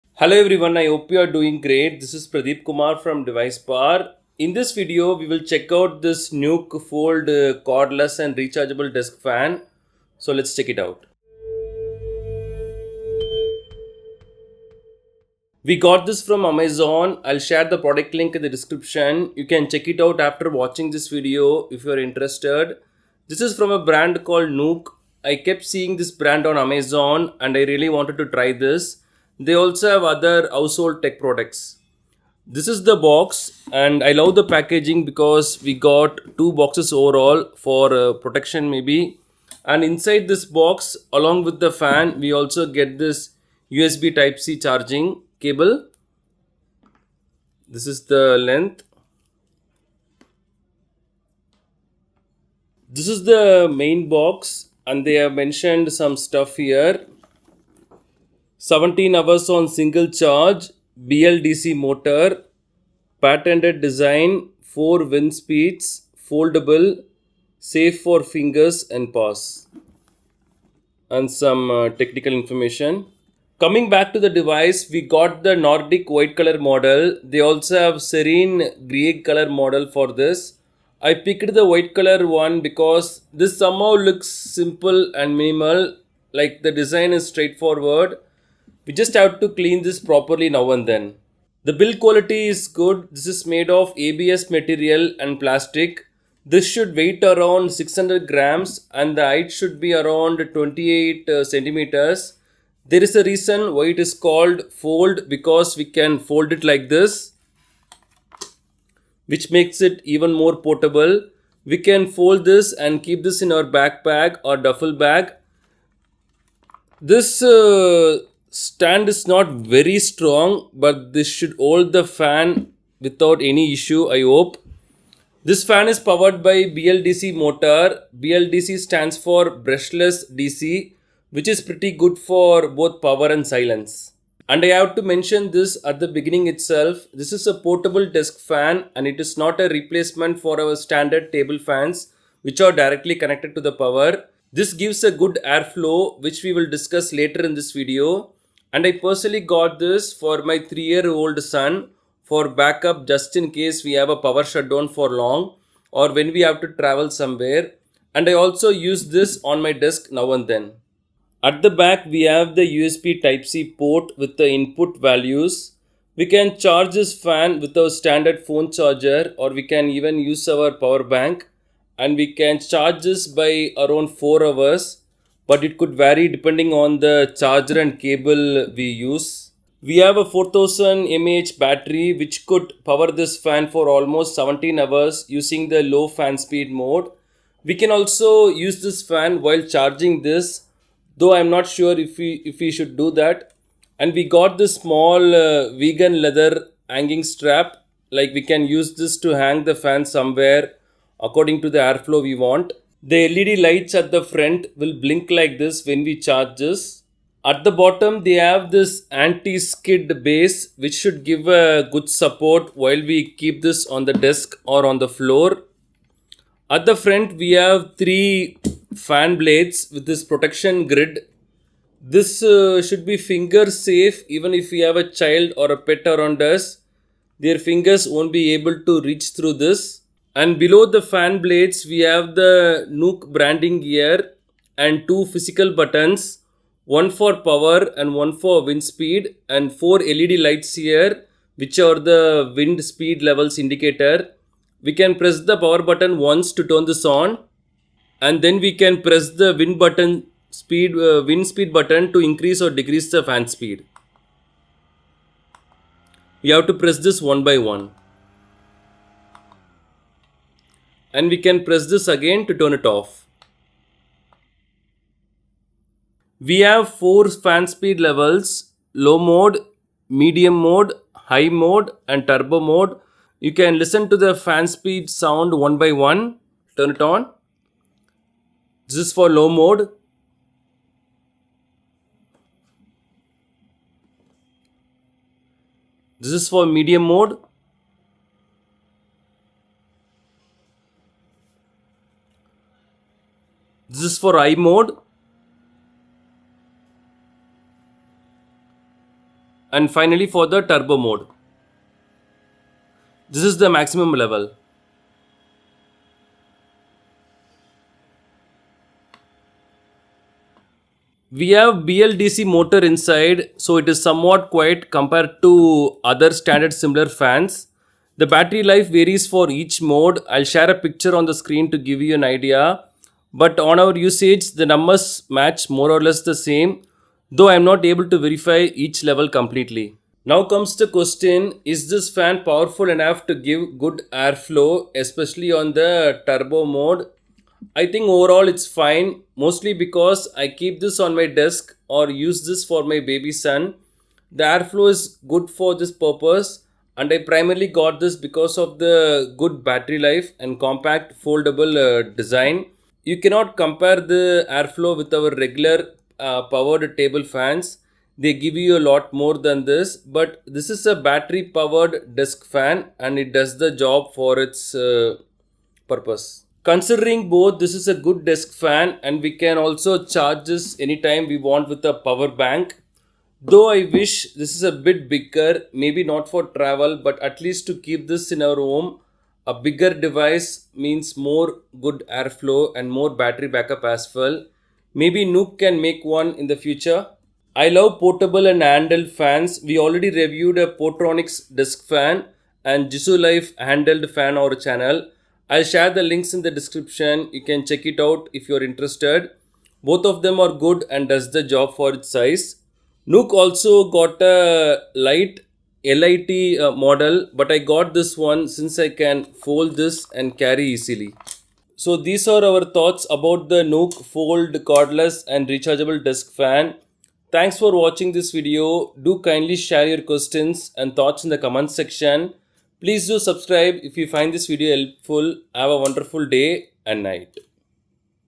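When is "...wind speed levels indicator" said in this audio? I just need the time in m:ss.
4:02.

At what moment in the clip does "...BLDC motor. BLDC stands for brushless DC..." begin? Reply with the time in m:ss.
2:06.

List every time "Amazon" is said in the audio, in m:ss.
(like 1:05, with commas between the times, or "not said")
0:16, 0:26.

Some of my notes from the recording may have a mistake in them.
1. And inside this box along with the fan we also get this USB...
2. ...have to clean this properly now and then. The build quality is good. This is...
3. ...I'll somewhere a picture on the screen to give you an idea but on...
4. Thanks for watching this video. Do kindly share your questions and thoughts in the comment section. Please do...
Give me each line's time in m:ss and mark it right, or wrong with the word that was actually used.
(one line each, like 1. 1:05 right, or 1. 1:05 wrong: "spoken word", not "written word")
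1. 0:39 right
2. 1:29 right
3. 5:20 wrong: "share", not "somewhere"
4. 6:57 right.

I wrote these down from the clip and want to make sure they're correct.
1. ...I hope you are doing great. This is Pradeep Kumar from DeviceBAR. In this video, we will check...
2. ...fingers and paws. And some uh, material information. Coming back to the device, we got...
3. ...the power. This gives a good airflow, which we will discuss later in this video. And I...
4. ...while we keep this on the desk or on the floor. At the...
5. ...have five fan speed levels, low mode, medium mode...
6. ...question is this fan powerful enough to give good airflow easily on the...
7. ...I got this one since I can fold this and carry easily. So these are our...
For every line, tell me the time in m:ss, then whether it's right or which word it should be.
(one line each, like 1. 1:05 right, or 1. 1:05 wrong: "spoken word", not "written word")
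1. 0:00 right
2. 1:08 wrong: "technical", not "material"
3. 2:23 right
4. 3:32 right
5. 4:26 wrong: "four", not "five"
6. 5:30 wrong: "especially", not "easily"
7. 6:47 right.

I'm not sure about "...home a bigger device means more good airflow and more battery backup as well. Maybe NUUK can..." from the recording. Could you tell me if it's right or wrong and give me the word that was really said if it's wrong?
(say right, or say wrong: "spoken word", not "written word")
right.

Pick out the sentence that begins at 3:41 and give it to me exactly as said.
This uh, should be finger safe even if we have a child or a pet around us.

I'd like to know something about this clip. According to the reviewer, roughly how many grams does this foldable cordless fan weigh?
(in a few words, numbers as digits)
600 grams.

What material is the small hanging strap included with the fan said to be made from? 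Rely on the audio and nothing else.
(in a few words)
vegan leather.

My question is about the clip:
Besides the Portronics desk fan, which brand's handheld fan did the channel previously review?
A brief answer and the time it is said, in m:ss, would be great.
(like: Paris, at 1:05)
JISULIFE, at 6:32.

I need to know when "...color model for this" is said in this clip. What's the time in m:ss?
1:19.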